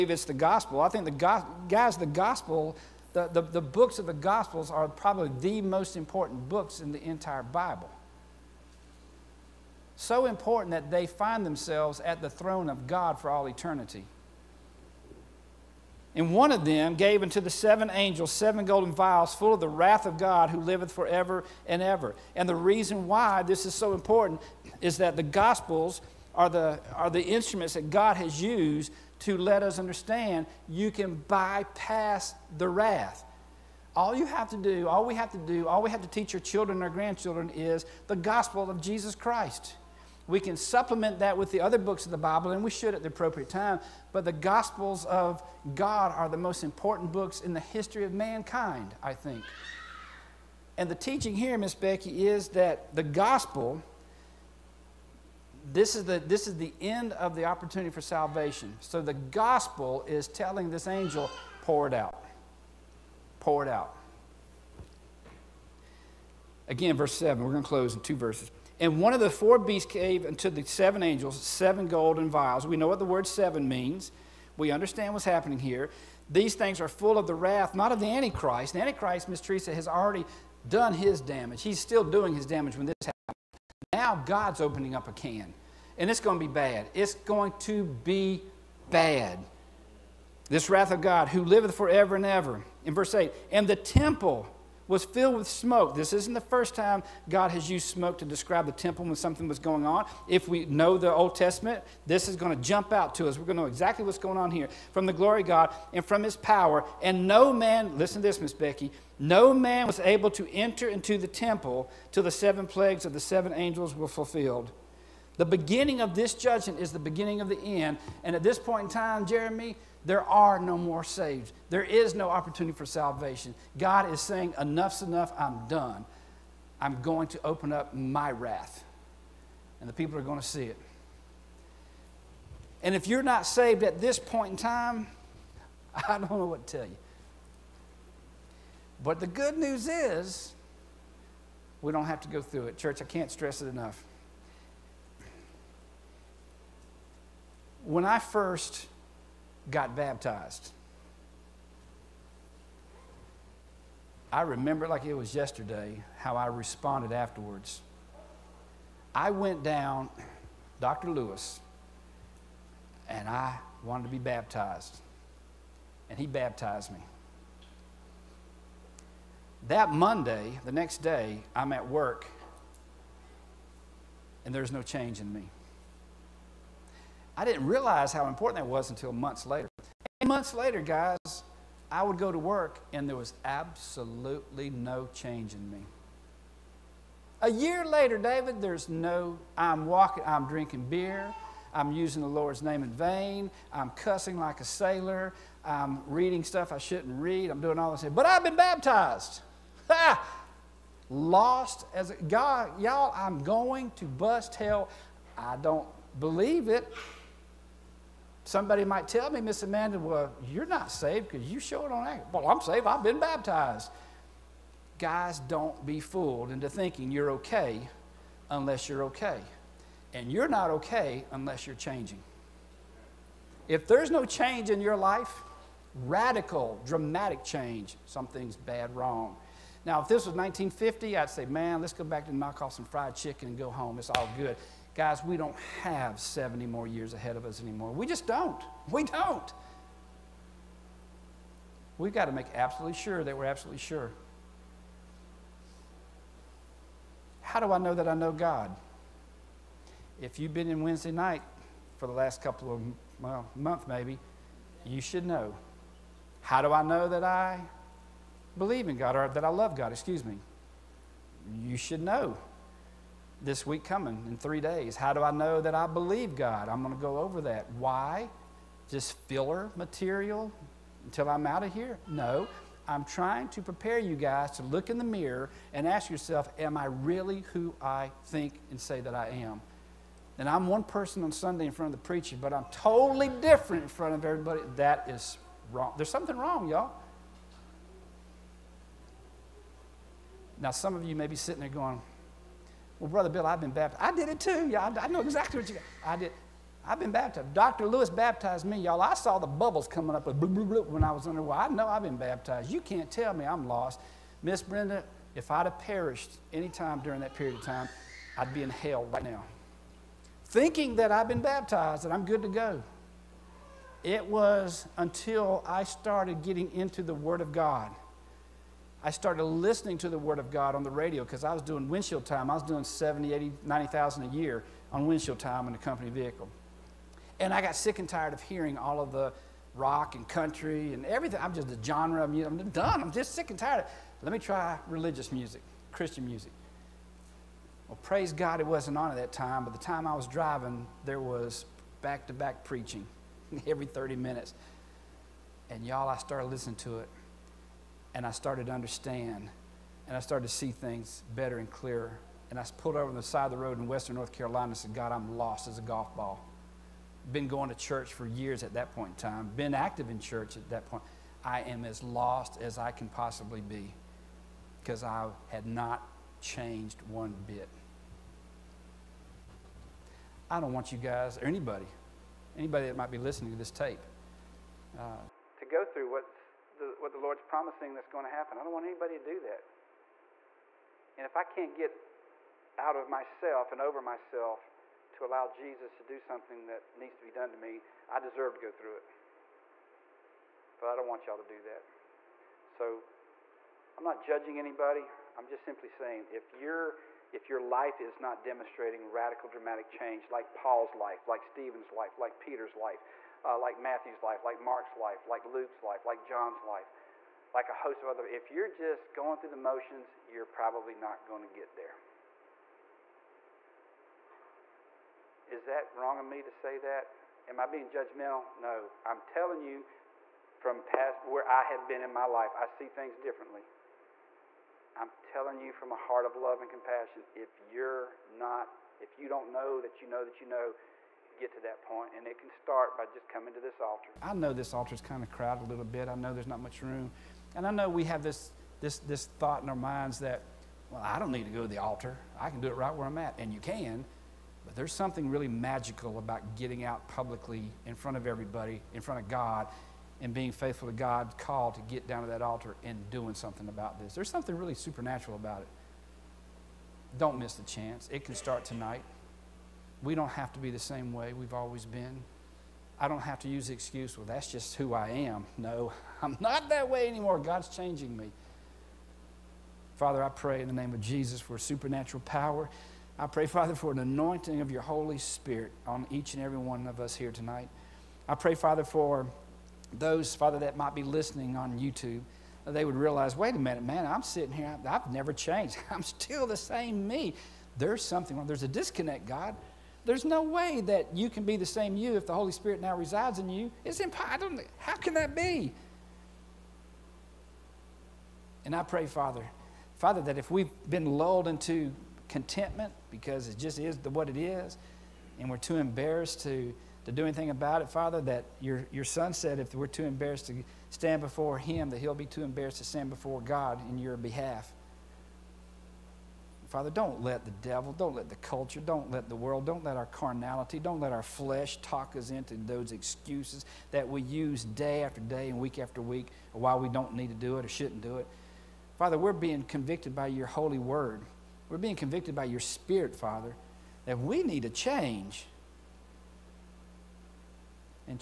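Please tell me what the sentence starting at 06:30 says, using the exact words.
But I don't want y'all to do that.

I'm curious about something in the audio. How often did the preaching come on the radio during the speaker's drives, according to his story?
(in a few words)
every 30 minutes.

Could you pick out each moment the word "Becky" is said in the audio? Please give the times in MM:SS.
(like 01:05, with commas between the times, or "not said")
00:51, 01:48.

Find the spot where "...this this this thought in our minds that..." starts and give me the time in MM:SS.
07:18.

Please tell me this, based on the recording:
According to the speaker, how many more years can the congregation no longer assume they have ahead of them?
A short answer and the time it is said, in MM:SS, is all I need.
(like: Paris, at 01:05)
70, at 03:56.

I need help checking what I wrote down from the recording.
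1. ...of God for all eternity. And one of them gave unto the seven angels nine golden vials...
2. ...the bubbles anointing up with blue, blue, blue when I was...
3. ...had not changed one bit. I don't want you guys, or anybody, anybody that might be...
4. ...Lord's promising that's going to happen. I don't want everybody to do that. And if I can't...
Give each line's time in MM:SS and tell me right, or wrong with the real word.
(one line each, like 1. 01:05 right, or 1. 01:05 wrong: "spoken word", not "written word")
1. 00:12 wrong: "seven", not "nine"
2. 04:59 wrong: "coming", not "anointing"
3. 06:05 right
4. 06:17 wrong: "anybody", not "everybody".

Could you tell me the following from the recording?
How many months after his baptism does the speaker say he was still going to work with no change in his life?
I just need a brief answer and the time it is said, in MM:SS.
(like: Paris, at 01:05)
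8, at 03:00.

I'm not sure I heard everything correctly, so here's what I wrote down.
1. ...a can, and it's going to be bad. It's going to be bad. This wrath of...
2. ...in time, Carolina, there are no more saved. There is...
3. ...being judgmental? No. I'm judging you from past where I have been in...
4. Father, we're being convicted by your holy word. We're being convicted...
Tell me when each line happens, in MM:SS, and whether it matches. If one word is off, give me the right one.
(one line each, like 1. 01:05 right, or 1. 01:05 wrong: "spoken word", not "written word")
1. 01:25 right
2. 01:58 wrong: "Jeremy", not "Carolina"
3. 06:57 wrong: "telling", not "judging"
4. 08:48 right.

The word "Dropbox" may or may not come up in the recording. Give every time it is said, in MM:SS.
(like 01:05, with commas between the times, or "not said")
not said.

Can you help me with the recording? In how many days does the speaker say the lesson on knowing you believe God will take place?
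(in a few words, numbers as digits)
3.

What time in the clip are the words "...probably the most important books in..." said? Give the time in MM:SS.
00:04.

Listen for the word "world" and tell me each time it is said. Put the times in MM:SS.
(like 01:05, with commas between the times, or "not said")
08:39.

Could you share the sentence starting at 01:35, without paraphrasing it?
This isn't the first time God has used smoke to describe the temple when something was going on.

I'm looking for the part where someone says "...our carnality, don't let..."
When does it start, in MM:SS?
08:39.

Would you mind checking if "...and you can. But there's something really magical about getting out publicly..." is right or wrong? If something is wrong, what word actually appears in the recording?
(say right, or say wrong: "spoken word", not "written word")
right.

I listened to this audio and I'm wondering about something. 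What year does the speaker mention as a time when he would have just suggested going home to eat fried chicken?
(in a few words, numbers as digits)
1950.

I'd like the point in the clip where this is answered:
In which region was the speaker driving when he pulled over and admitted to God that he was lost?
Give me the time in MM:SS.
05:53.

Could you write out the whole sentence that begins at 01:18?
The Antichrist, Miss Teresa, has already done his damage.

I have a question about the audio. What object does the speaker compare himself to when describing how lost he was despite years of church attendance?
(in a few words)
a golf ball.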